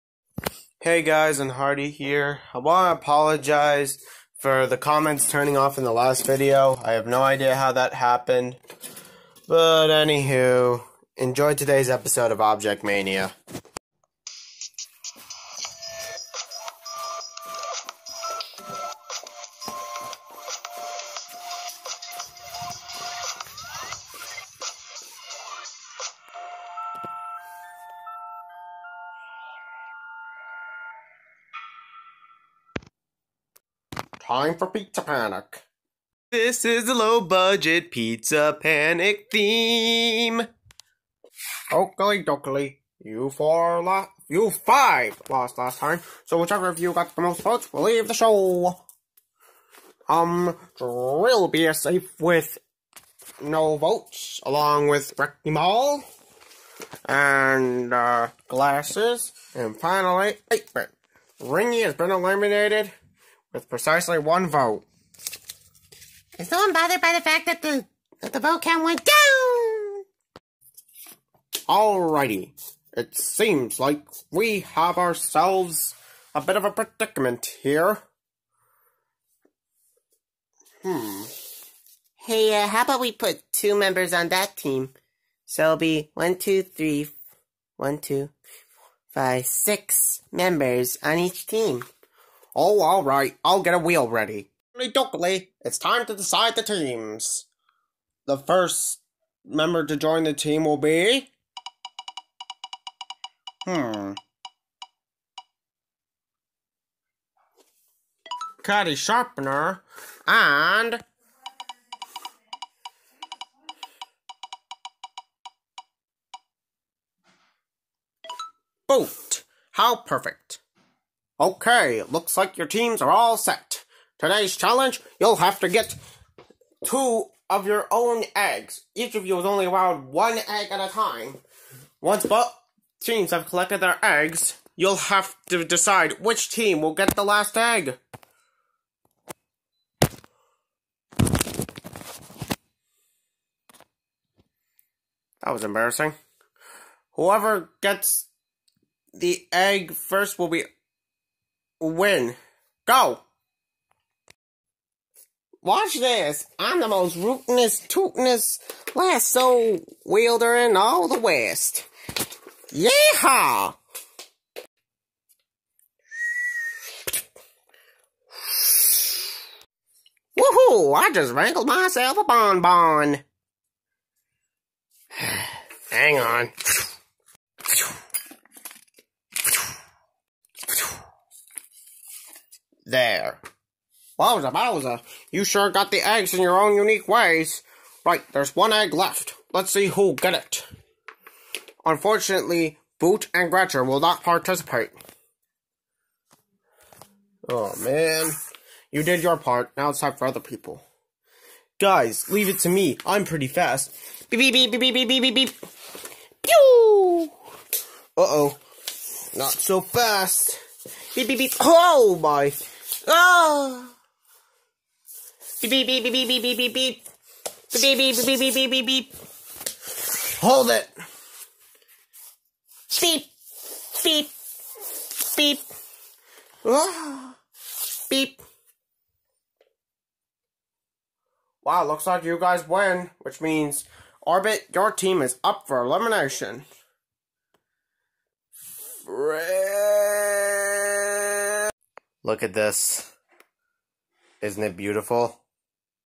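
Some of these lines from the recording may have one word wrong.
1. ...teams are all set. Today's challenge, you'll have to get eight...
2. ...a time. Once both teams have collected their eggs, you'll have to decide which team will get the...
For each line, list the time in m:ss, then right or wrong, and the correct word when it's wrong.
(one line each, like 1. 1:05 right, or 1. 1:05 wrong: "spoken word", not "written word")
1. 2:02 wrong: "two", not "eight"
2. 2:10 right.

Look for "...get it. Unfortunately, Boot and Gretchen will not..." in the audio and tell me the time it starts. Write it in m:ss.
3:10.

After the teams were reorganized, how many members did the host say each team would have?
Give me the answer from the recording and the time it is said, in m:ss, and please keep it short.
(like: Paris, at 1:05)
6, at 1:29.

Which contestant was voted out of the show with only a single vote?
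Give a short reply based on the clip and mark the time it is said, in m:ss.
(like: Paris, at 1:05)
Ringy, at 1:01.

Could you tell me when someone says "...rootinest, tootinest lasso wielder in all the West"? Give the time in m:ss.
2:37.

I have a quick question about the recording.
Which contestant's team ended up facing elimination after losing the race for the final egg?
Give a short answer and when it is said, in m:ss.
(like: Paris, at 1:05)
Orbit, at 3:54.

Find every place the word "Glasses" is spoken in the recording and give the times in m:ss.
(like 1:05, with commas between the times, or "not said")
0:58.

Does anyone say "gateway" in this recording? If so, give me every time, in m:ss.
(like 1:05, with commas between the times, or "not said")
not said.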